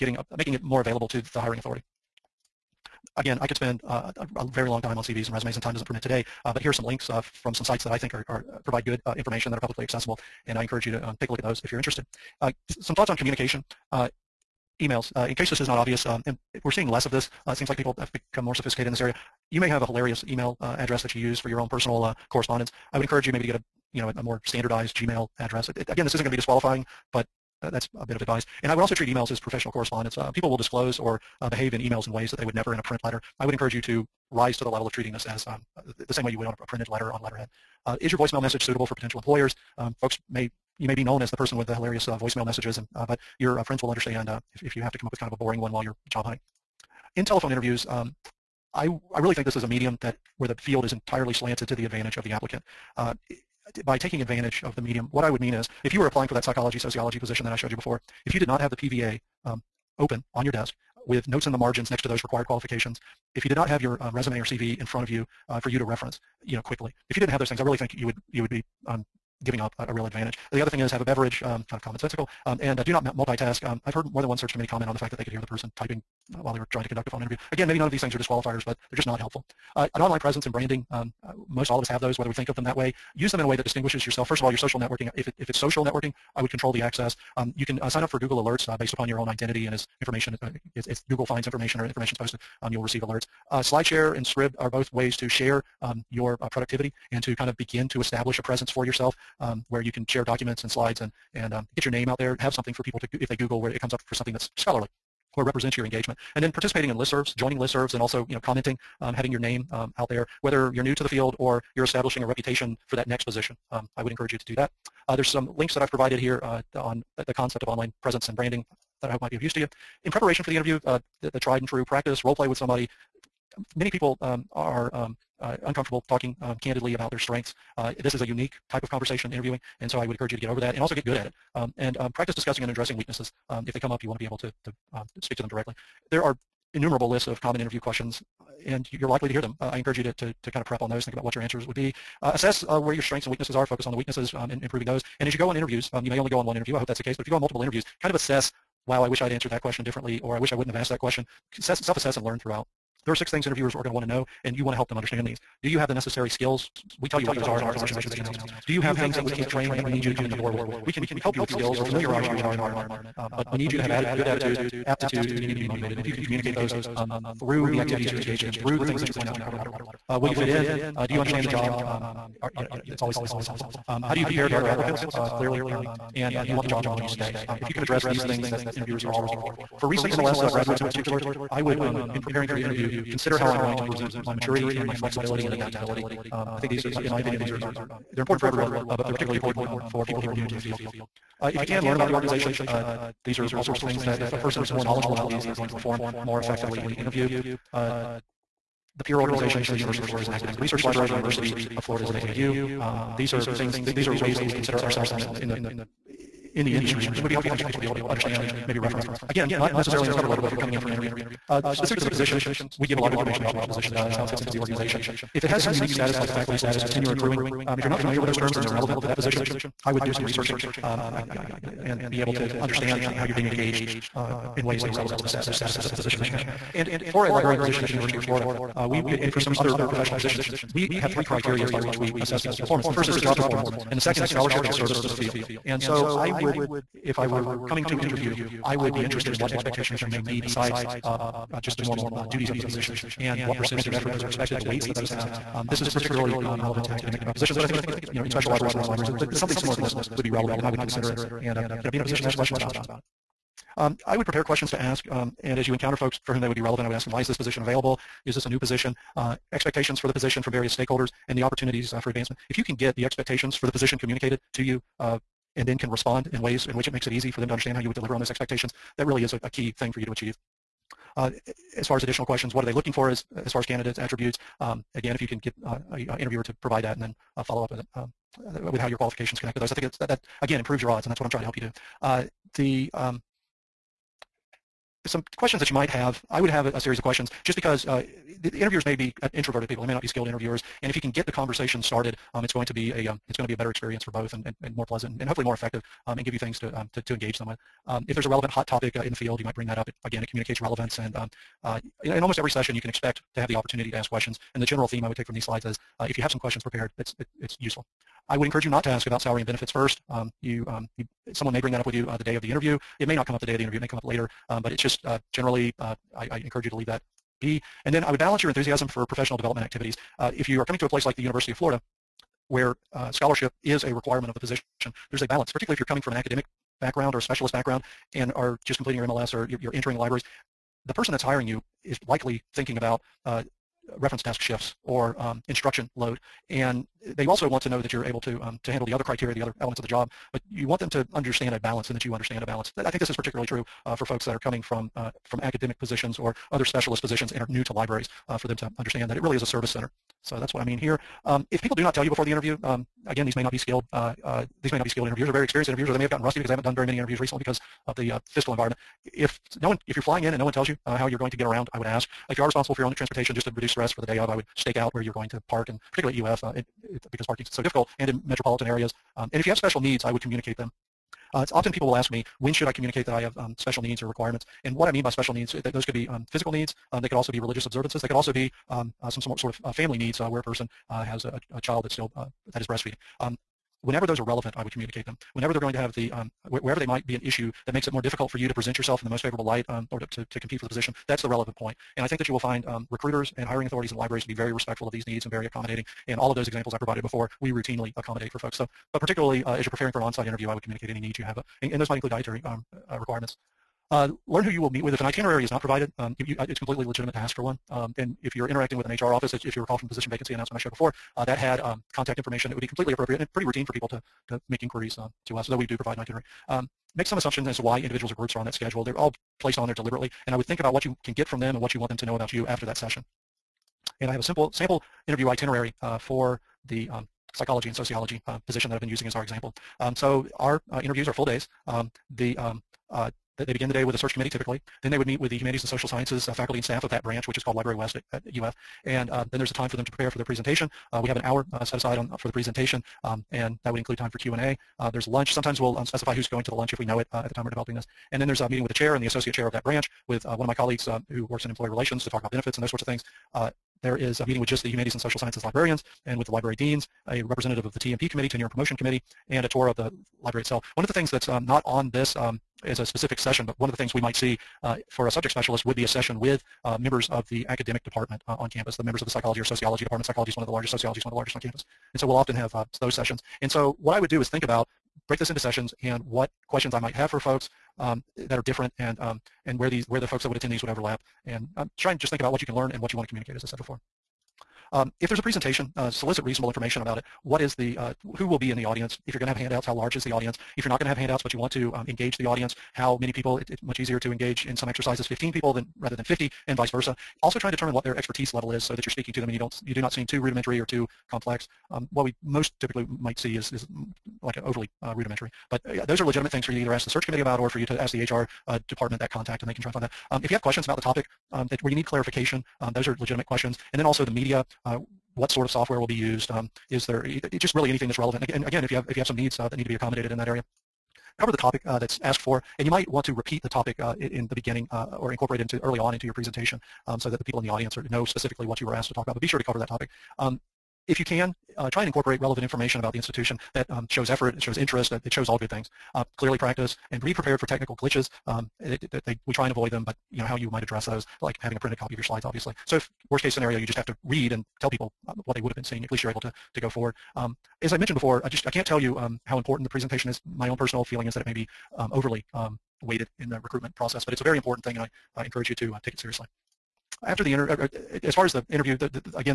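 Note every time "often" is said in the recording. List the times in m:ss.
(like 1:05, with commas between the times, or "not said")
6:11, 7:52.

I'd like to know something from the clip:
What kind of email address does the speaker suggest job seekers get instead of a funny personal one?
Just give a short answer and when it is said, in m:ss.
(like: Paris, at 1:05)
Standardized Gmail address, at 0:24.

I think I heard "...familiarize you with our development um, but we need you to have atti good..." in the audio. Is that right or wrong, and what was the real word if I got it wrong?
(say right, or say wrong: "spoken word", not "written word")
wrong: "environment", not "development".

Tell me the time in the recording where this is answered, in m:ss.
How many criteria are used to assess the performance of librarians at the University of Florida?
3:51.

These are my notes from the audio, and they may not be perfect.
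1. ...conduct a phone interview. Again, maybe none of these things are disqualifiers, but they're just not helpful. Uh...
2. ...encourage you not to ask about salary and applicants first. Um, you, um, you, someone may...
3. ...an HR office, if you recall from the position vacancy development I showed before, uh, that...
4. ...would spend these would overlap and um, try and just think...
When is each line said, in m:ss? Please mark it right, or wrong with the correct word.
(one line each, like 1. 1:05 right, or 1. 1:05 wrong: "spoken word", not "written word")
1. 1:16 right
2. 5:08 wrong: "benefits", not "applicants"
3. 6:48 wrong: "announcement", not "development"
4. 8:00 wrong: "attend", not "spend".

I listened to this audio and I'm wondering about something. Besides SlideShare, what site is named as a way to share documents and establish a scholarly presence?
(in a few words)
Scribd.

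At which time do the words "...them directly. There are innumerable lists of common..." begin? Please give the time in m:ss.
2:15.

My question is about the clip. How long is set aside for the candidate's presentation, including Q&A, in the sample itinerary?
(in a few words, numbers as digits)
An hour.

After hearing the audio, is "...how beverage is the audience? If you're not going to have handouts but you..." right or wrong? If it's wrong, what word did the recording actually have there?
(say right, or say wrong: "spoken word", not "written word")
wrong: "large", not "beverage".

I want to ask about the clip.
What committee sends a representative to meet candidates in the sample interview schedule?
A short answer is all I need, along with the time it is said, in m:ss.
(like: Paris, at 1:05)
Tenure and Promotion Committee, at 7:38.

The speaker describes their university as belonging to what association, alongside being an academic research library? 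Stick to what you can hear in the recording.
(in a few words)
AAU.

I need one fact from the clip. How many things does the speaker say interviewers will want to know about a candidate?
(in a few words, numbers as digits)
6.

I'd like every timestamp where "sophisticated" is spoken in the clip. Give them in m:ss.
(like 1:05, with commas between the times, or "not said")
0:18.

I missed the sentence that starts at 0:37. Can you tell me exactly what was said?
Uh, is your voicemail message suitable for potential employers?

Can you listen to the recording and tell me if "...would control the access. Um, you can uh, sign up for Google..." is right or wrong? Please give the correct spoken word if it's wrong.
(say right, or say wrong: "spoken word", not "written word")
right.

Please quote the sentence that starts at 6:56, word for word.
Um, make some assumptions as to why individuals or groups are on that schedule.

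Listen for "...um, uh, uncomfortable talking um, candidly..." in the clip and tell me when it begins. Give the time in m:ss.
2:04.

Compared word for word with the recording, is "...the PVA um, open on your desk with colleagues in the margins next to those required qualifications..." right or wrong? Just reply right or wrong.
wrong.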